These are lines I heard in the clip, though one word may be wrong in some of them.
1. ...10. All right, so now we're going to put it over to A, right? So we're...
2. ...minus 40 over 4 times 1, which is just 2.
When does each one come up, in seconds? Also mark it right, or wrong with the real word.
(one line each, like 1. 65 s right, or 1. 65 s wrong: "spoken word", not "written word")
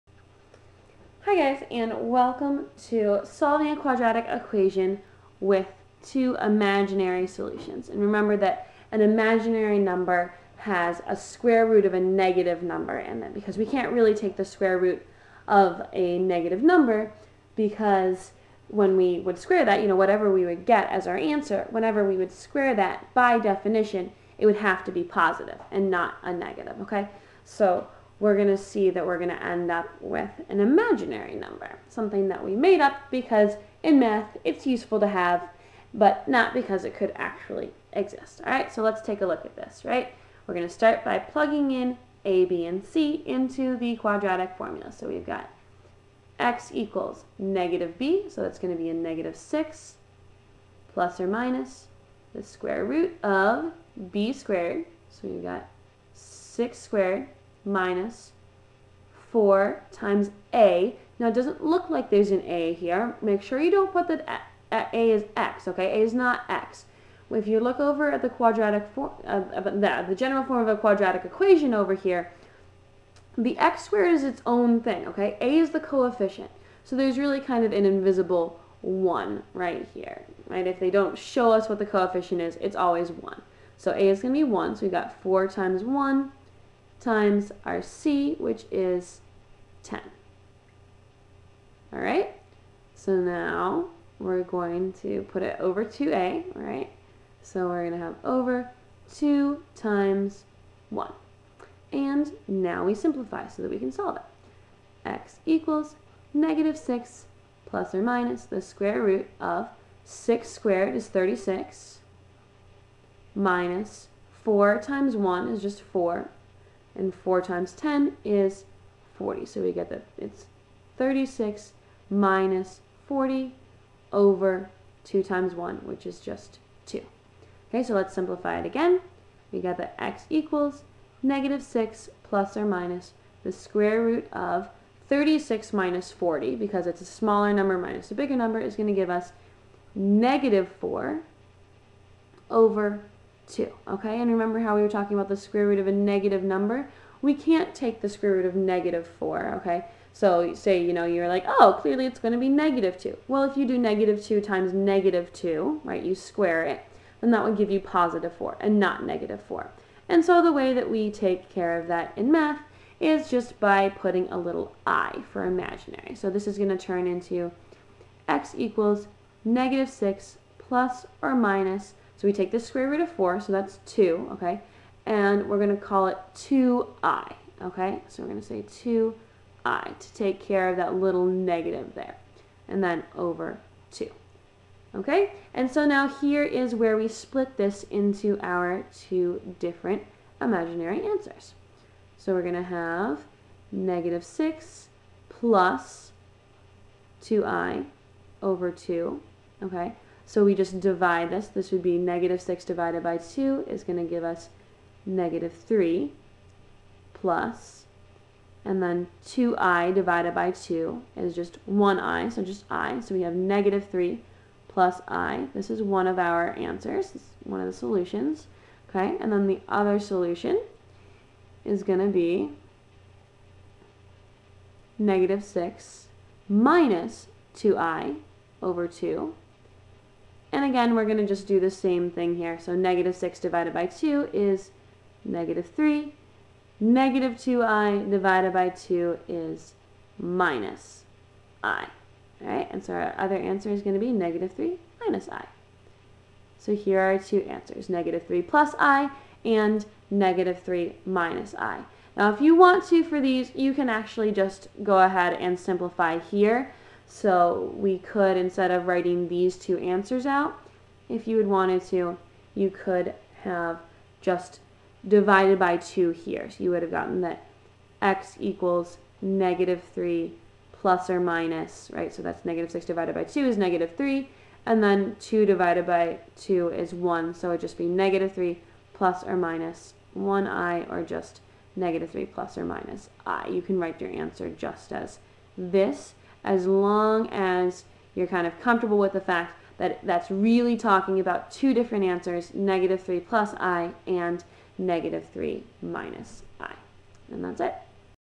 1. 89 s right
2. 122 s wrong: "2", not "4".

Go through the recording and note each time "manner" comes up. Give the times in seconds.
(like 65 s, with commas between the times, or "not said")
not said.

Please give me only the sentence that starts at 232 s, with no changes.
So negative 6 divided by 2 is negative 3.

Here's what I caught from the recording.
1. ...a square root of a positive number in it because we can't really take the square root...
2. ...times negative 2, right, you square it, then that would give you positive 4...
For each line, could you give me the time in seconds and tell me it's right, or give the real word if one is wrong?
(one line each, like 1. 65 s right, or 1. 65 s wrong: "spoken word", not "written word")
1. 11 s wrong: "negative", not "positive"
2. 154 s right.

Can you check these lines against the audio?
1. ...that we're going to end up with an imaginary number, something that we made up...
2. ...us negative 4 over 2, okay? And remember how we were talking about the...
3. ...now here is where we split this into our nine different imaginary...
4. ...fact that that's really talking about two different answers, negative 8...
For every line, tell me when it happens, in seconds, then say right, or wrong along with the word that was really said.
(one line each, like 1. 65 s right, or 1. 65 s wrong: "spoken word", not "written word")
1. 28 s right
2. 139 s right
3. 185 s wrong: "two", not "nine"
4. 289 s wrong: "3", not "8".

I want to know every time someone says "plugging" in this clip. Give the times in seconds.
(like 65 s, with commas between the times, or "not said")
41 s.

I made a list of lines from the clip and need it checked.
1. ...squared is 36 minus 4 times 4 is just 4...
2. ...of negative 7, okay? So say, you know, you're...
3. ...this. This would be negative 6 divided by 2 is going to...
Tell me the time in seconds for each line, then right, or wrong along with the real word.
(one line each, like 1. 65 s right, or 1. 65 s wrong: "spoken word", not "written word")
1. 110 s wrong: "1", not "4"
2. 148 s wrong: "4", not "7"
3. 201 s right.